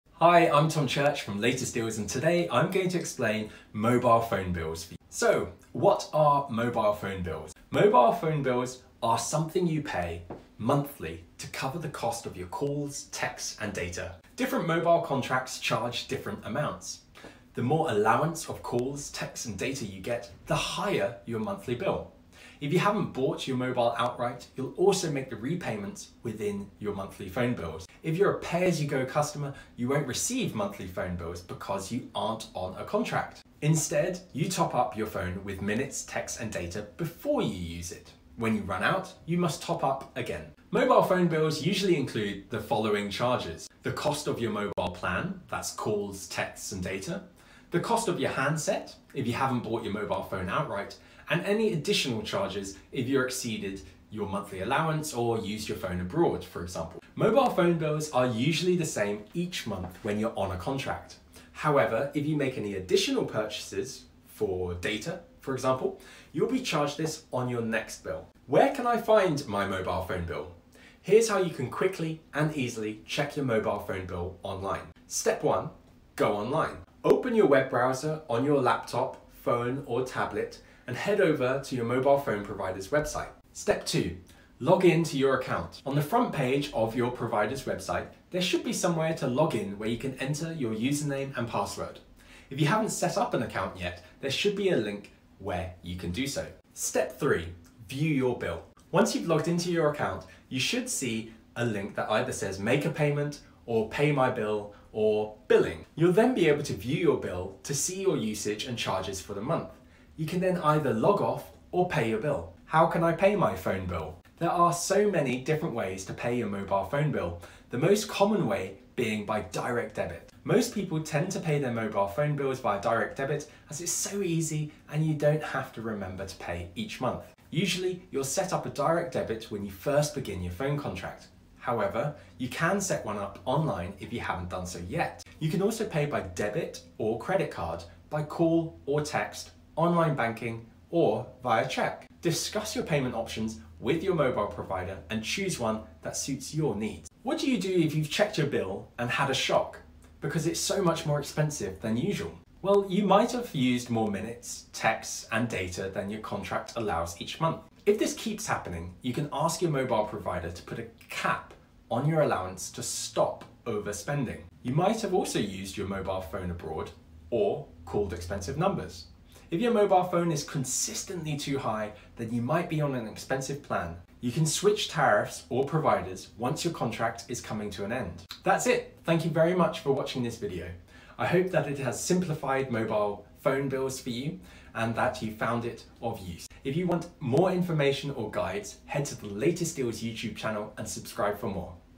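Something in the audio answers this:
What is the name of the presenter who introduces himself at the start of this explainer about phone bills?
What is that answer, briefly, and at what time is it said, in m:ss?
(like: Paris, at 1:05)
Tom Church, at 0:00.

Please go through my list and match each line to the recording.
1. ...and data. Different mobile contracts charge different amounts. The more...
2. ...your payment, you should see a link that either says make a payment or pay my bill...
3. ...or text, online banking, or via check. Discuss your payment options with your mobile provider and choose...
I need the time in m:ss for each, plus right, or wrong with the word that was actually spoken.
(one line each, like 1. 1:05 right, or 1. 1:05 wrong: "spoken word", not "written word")
1. 0:13 right
2. 1:39 wrong: "account", not "payment"
3. 2:18 right.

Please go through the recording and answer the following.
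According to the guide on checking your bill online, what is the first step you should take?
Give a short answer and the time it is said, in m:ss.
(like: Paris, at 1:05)
Go online, at 1:16.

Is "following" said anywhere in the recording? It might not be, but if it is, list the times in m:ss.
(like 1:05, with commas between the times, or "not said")
0:42.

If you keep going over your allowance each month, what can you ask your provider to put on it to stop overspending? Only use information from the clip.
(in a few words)
A cap.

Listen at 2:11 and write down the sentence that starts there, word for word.
However, you can set one up online if you haven't done so yet.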